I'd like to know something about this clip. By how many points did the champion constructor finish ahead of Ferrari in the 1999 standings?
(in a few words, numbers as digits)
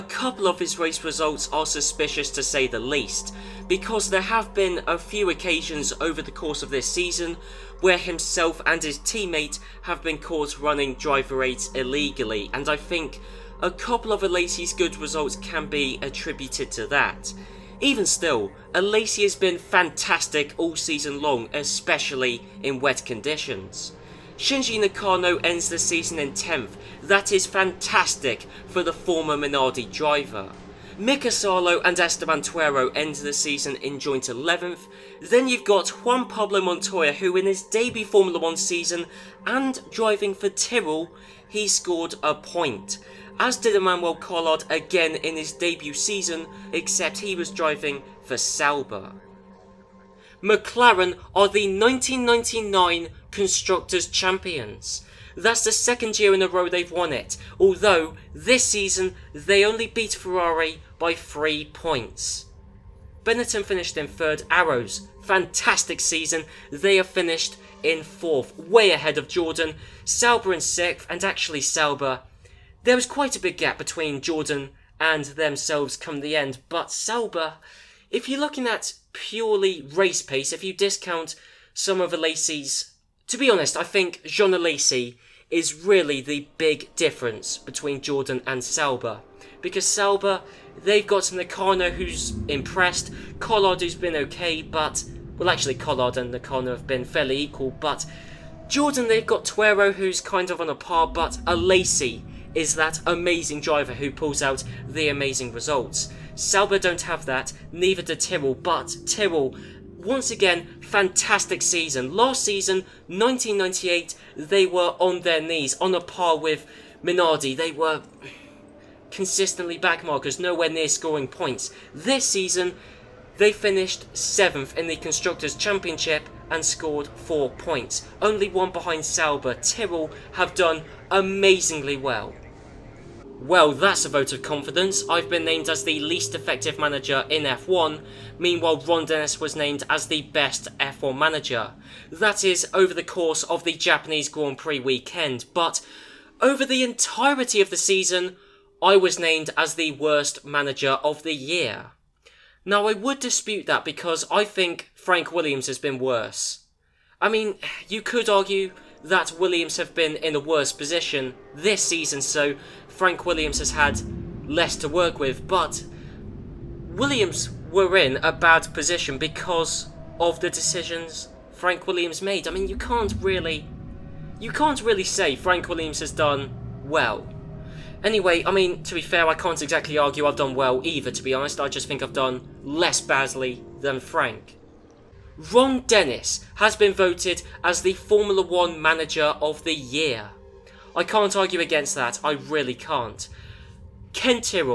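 3.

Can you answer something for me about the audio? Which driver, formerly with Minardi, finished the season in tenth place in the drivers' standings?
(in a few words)
Shinji Nakano.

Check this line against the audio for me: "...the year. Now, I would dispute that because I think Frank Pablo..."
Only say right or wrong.
wrong.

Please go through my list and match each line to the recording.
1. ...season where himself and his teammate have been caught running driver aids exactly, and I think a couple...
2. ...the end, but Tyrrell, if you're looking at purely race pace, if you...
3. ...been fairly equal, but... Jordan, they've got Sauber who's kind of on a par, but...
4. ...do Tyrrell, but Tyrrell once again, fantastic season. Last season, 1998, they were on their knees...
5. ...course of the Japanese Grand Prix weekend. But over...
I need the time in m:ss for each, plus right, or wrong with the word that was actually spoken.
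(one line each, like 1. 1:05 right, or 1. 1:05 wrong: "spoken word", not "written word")
1. 0:06 wrong: "illegally", not "exactly"
2. 1:16 wrong: "Sauber", not "Tyrrell"
3. 1:36 wrong: "Tuero", not "Sauber"
4. 1:48 right
5. 2:23 right.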